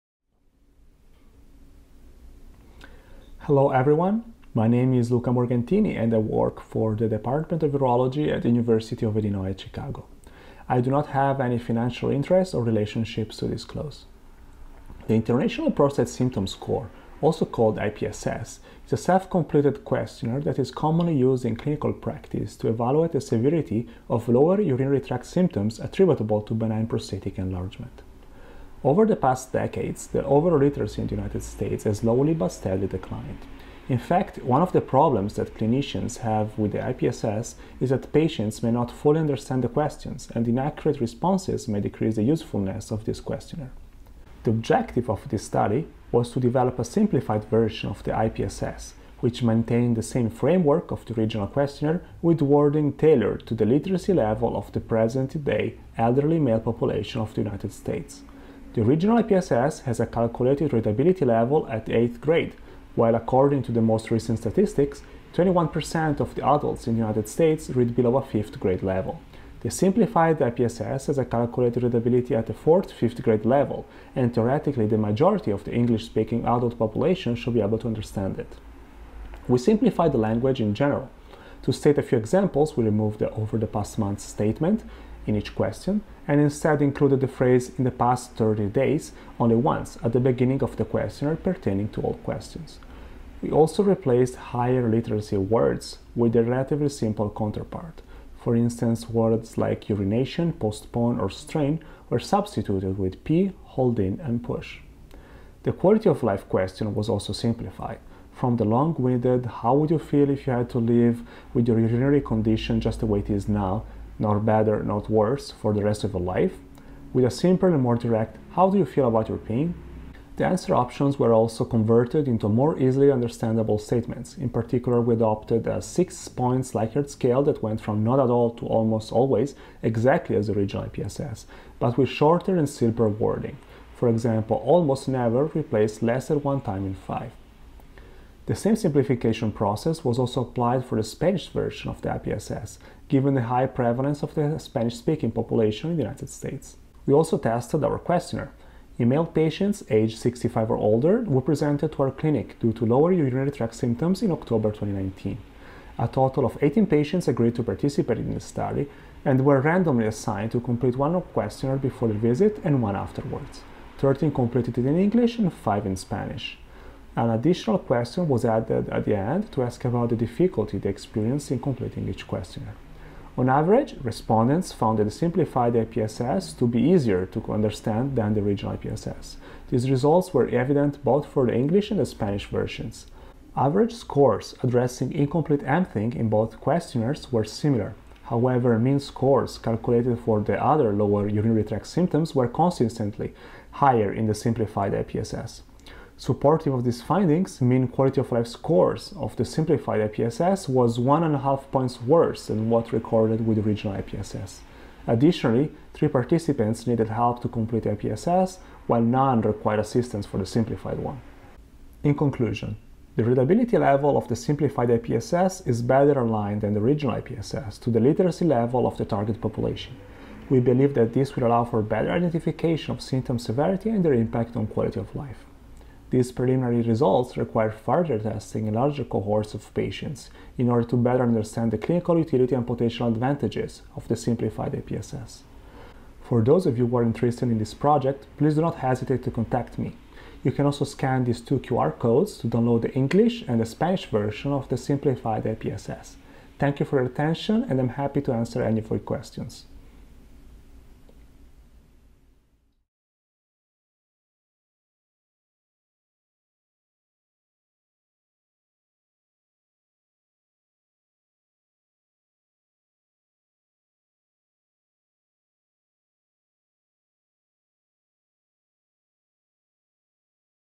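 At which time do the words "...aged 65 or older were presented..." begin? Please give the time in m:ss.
2:29.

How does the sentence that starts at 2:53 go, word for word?
On average, respondents found the simplified IPSS to be easier to understand than the original IPSS.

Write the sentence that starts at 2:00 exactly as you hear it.
The answer options were also converted into more easily understandable statements.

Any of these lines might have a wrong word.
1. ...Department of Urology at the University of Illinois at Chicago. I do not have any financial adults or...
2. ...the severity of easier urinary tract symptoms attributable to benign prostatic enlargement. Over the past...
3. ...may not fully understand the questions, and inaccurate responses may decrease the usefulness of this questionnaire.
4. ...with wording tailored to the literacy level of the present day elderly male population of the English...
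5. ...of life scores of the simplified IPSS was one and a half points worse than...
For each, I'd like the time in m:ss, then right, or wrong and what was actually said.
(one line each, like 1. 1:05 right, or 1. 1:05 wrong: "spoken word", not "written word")
1. 0:07 wrong: "interests", not "adults"
2. 0:23 wrong: "lower", not "easier"
3. 0:38 right
4. 0:52 wrong: "United", not "English"
5. 3:18 right.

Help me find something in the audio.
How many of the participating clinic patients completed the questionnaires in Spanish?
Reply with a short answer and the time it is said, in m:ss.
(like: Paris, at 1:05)
5, at 2:45.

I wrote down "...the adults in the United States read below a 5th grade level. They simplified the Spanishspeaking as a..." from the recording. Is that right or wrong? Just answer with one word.
wrong.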